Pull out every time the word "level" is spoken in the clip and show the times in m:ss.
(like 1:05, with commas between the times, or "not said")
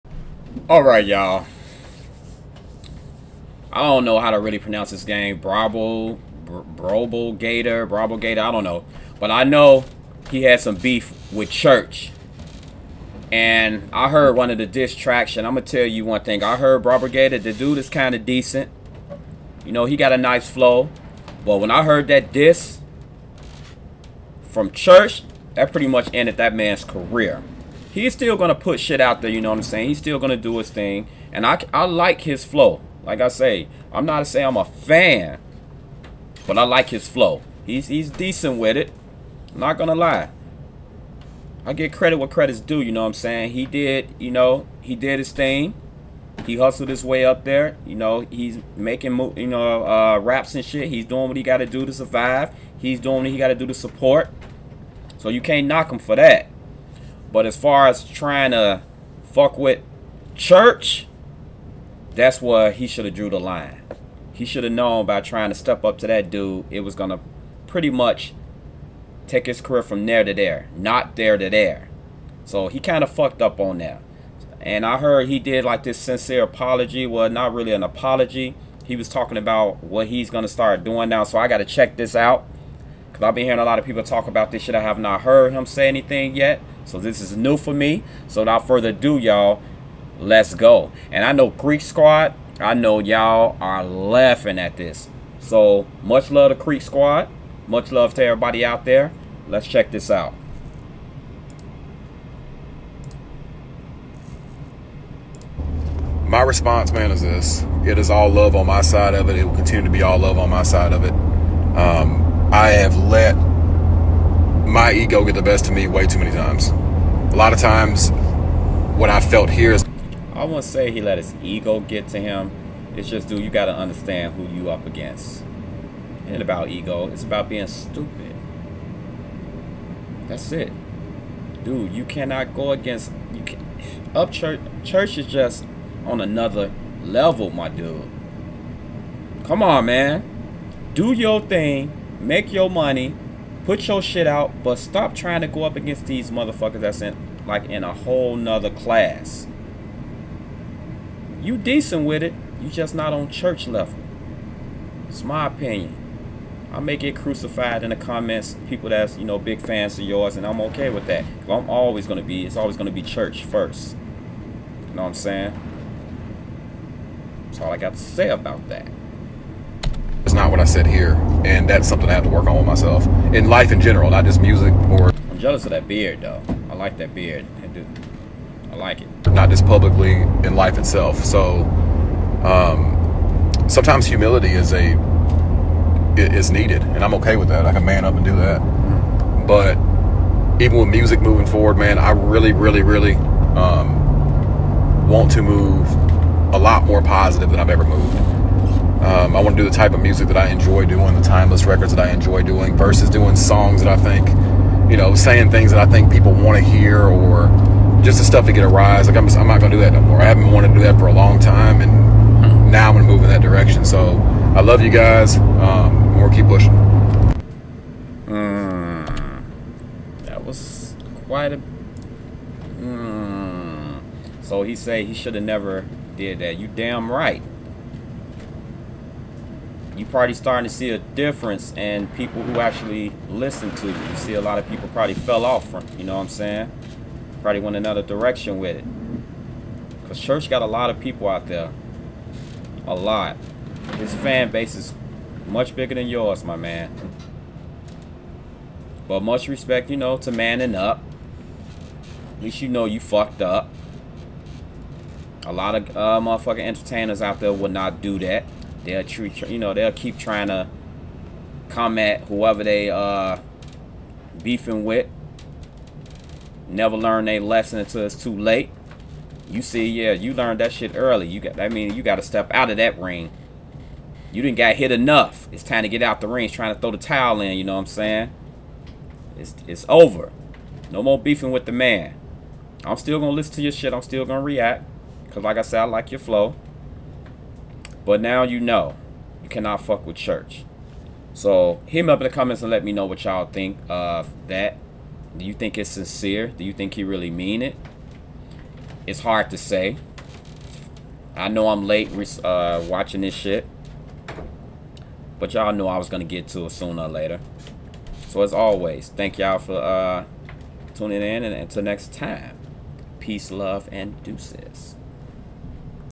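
2:17, 2:33.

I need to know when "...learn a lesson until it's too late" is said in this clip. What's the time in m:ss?
4:26.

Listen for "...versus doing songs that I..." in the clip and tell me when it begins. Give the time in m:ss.
3:22.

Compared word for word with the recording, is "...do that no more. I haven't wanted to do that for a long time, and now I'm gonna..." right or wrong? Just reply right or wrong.
right.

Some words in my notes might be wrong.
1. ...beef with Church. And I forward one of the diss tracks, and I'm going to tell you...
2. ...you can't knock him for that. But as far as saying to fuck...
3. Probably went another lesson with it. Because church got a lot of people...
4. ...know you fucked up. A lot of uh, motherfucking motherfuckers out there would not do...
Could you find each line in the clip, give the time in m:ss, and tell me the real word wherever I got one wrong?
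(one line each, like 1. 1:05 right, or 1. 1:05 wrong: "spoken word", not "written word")
1. 0:10 wrong: "heard", not "forward"
2. 0:55 wrong: "trying", not "saying"
3. 3:57 wrong: "direction", not "lesson"
4. 4:12 wrong: "entertainers", not "motherfuckers".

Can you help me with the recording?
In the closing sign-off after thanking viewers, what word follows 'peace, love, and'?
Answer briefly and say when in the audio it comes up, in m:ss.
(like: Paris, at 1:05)
deuces, at 5:14.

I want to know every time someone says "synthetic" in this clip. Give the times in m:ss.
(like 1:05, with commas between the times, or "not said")
not said.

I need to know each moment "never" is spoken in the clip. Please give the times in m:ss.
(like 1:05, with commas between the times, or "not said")
3:45, 4:26.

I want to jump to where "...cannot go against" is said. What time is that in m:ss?
2:12.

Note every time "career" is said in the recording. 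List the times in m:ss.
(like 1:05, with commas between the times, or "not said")
0:26, 1:09.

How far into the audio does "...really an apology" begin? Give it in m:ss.
1:17.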